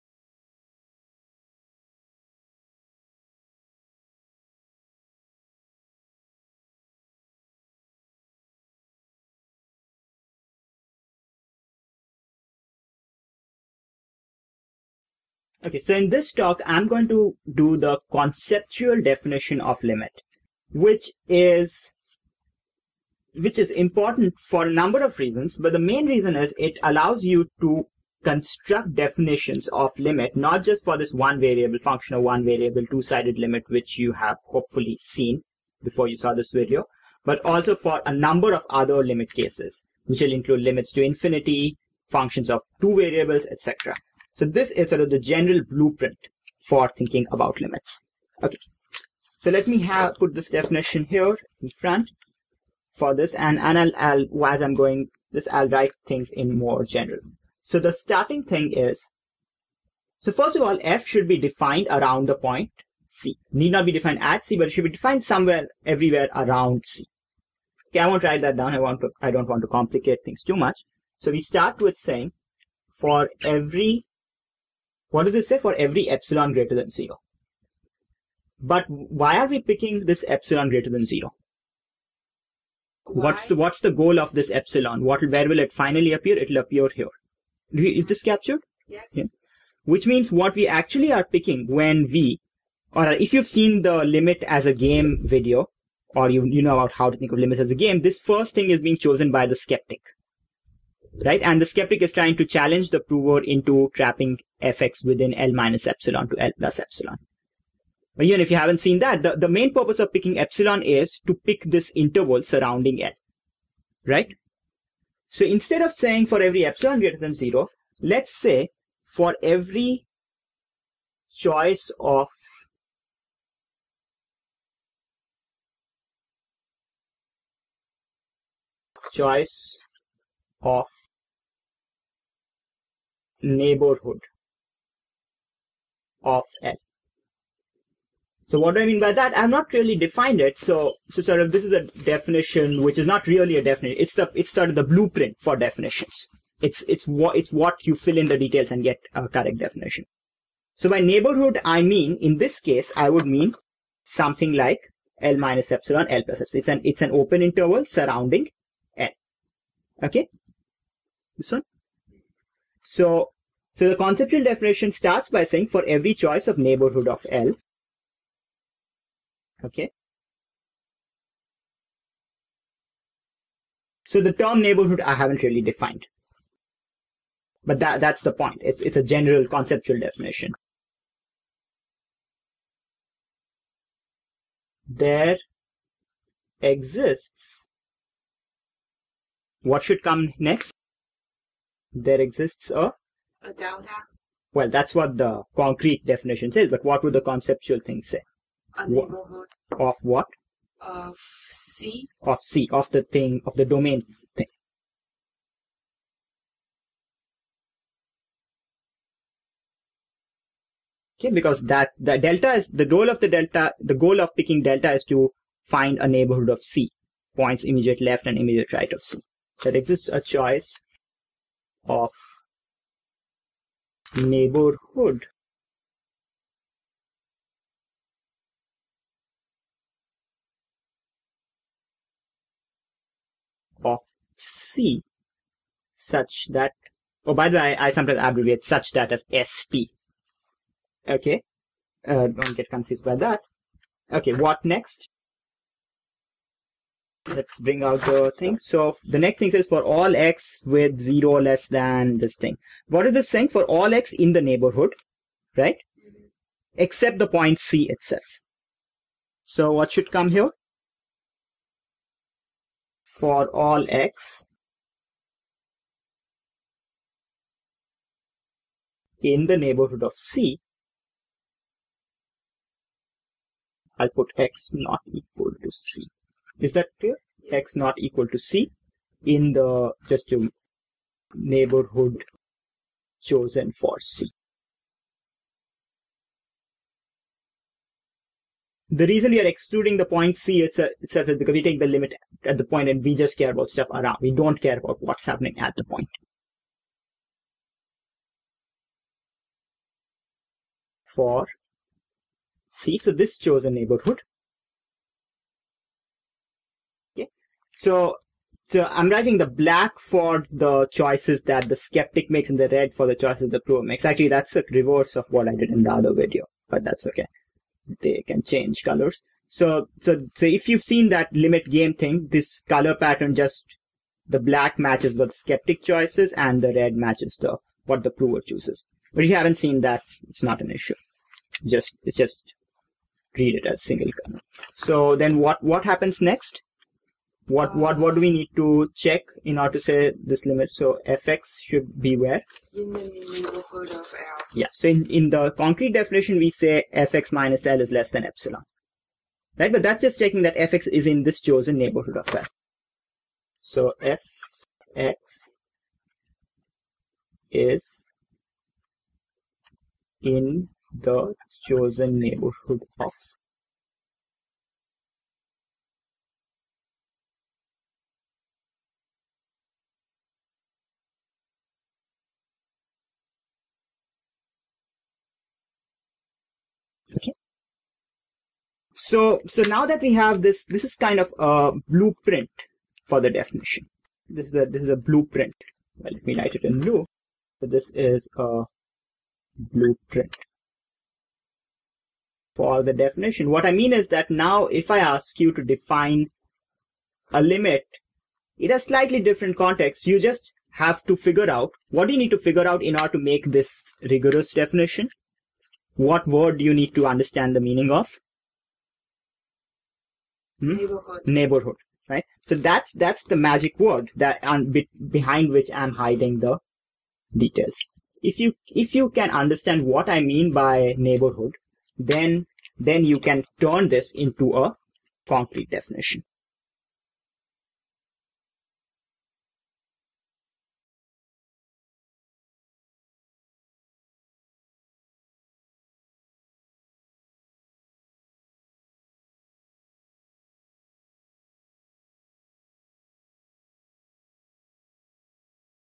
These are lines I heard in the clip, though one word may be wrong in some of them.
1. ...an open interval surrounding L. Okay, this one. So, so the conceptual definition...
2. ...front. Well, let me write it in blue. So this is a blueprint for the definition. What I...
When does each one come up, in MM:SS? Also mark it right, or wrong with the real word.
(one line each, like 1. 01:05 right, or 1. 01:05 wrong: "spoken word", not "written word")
1. 02:37 right
2. 06:24 wrong: "blueprint", not "front".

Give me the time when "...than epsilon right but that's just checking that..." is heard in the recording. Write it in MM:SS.
05:48.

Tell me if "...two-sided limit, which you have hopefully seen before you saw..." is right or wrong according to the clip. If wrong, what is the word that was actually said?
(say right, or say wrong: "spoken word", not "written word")
right.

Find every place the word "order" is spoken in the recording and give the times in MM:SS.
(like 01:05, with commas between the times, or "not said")
05:39, 06:42.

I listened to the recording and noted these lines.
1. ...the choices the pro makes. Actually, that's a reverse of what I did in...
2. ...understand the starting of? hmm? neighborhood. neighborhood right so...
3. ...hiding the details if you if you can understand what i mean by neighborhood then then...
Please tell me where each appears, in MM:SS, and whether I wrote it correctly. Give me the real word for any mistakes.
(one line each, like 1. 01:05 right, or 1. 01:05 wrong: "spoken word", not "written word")
1. 05:13 right
2. 06:47 wrong: "meaning", not "starting"
3. 06:55 right.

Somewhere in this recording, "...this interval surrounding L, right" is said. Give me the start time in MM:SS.
01:51.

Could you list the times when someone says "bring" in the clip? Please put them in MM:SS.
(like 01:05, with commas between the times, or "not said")
04:07.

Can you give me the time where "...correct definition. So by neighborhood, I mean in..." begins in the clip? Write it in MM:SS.
02:29.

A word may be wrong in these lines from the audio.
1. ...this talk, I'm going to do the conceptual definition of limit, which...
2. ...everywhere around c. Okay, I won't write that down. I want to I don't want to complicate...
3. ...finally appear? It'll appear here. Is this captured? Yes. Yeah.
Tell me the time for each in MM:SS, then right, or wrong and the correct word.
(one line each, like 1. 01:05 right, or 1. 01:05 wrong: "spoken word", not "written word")
1. 00:16 right
2. 01:05 right
3. 01:25 right.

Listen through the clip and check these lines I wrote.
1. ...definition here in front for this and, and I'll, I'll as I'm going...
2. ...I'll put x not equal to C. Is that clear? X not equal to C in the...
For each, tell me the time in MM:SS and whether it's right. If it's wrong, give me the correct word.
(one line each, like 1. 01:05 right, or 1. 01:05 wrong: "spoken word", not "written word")
1. 00:50 right
2. 04:33 right.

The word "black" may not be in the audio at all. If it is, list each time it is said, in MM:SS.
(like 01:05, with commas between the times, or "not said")
05:09, 05:24.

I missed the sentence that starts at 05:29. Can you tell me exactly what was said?
But if you haven't seen that, it's not an issue.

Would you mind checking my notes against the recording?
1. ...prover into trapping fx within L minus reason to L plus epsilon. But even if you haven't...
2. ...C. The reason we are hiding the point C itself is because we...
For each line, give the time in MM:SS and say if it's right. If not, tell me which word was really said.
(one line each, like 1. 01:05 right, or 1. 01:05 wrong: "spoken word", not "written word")
1. 01:42 wrong: "epsilon", not "reason"
2. 04:43 wrong: "excluding", not "hiding".